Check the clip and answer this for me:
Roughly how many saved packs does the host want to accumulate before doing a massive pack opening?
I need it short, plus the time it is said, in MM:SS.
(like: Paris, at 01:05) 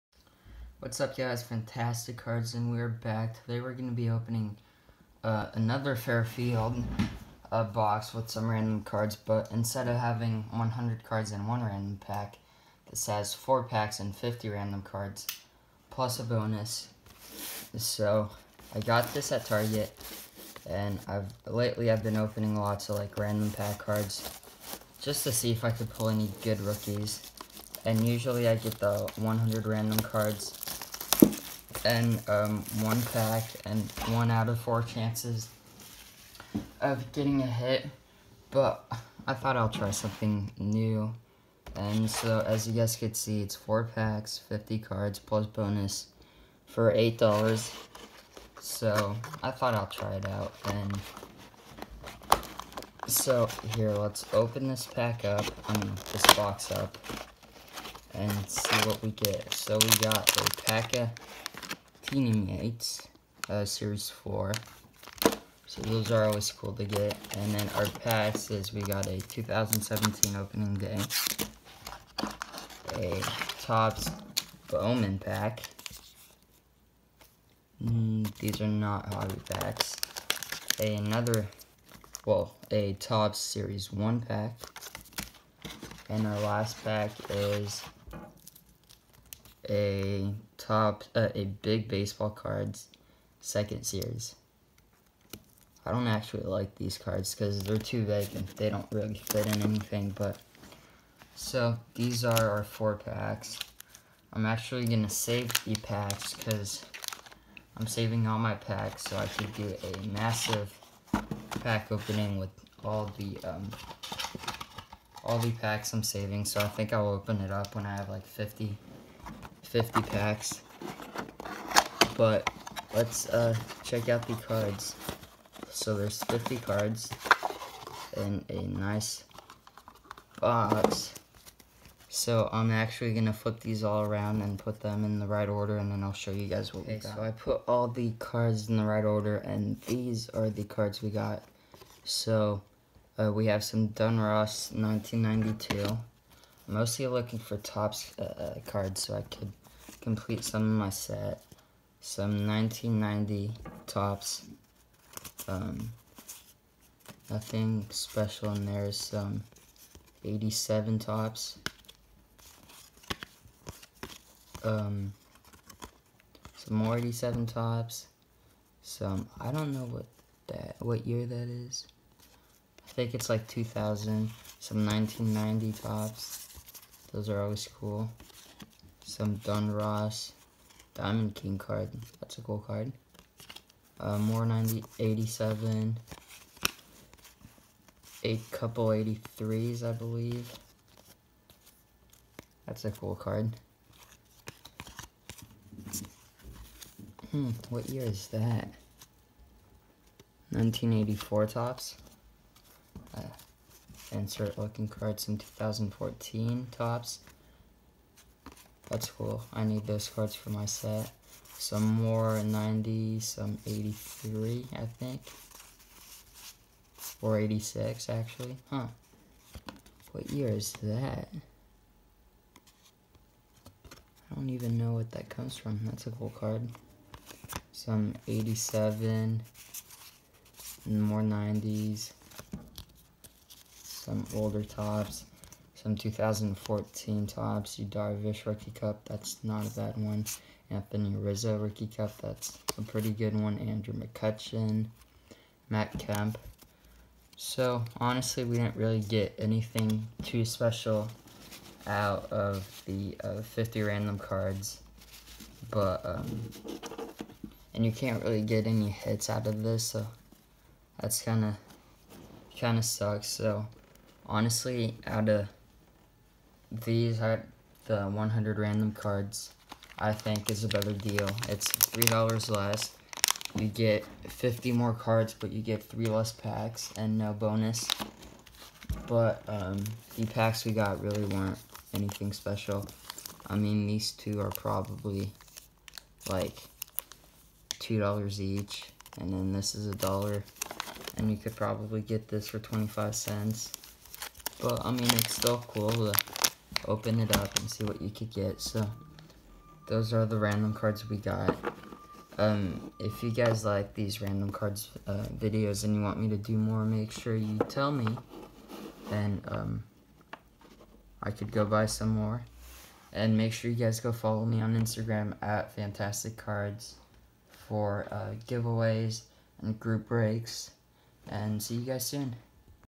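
50, at 01:58.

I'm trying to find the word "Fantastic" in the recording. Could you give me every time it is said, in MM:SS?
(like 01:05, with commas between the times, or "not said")
00:01, 05:15.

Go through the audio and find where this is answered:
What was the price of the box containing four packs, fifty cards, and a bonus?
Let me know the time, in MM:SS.
00:46.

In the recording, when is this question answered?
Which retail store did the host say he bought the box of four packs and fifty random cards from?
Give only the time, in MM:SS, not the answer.
00:19.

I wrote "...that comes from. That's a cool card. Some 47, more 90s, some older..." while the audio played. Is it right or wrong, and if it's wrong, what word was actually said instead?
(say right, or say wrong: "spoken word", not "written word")
wrong: "87", not "47".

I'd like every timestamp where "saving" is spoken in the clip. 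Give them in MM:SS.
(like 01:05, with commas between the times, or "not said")
01:47, 01:56.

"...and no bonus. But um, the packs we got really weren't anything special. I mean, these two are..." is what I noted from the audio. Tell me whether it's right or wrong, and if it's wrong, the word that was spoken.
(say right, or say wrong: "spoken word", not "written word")
right.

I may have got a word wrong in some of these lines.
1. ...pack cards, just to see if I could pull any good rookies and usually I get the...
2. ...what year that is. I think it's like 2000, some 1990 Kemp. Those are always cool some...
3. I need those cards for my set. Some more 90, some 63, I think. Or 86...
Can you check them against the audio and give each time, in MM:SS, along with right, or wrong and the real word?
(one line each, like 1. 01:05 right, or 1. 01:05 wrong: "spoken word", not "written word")
1. 00:23 right
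2. 02:50 wrong: "Topps", not "Kemp"
3. 03:29 wrong: "83", not "63".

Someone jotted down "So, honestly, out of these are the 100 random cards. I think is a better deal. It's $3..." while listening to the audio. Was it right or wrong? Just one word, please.
right.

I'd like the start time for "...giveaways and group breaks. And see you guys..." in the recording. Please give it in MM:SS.
05:18.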